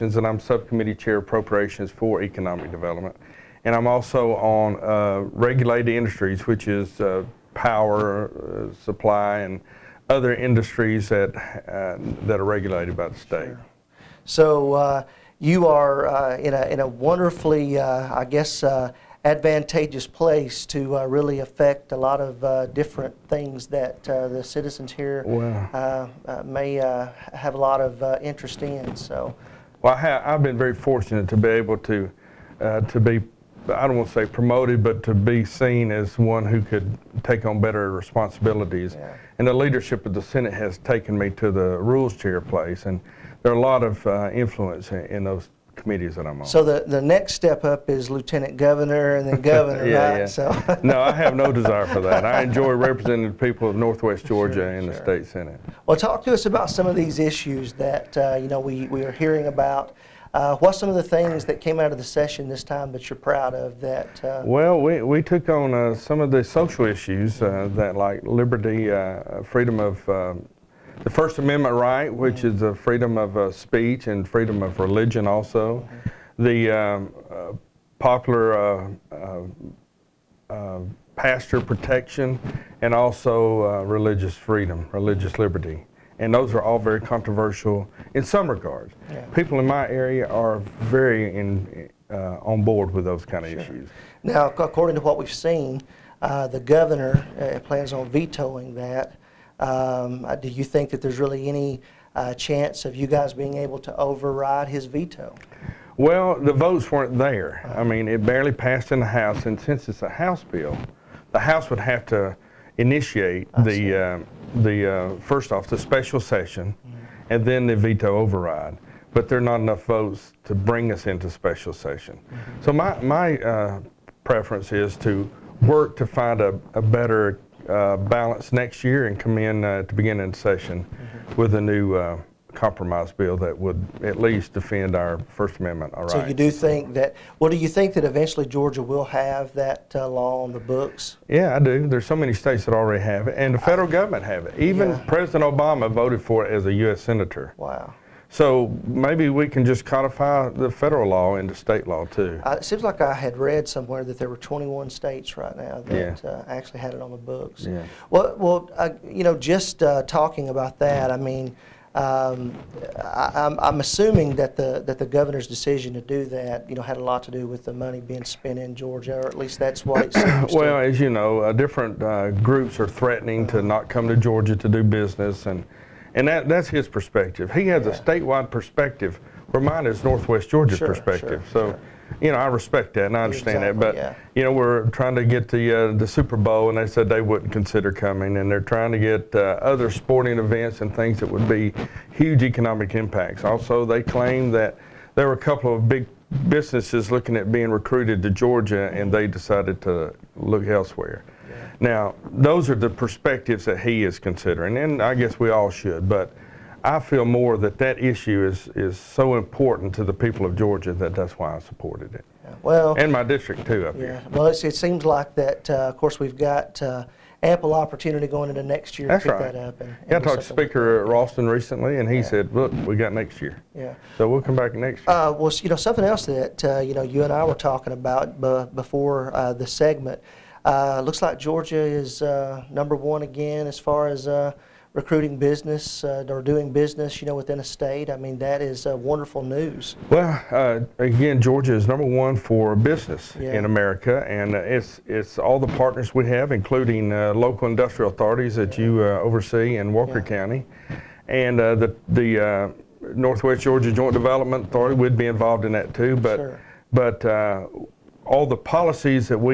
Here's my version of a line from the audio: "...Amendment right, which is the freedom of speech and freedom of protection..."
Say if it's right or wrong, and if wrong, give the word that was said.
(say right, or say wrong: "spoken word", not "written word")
wrong: "religion", not "protection".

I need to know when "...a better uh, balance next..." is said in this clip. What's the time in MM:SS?
02:06.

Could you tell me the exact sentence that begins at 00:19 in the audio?
advantageous place to really affect a lot of different things that the citizens here may have a lot of interest in.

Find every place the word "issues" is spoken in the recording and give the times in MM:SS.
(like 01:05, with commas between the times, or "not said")
00:57, 01:06, 01:33, 03:28.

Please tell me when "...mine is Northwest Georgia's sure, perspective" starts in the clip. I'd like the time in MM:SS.
02:59.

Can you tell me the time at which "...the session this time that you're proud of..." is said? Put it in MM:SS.
01:01.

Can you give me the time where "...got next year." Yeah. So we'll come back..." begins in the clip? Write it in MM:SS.
03:42.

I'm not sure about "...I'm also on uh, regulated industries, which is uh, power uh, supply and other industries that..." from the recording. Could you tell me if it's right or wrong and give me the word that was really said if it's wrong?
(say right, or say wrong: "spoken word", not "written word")
right.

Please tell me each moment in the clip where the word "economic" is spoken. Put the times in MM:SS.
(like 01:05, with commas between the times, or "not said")
00:02, 03:12.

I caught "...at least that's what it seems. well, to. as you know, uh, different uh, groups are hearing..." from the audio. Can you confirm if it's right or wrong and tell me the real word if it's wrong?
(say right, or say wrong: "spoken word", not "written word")
wrong: "threatening", not "hearing".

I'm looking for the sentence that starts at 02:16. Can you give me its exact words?
So you do think that, well, do you think that eventually Georgia will have that uh, law on the books?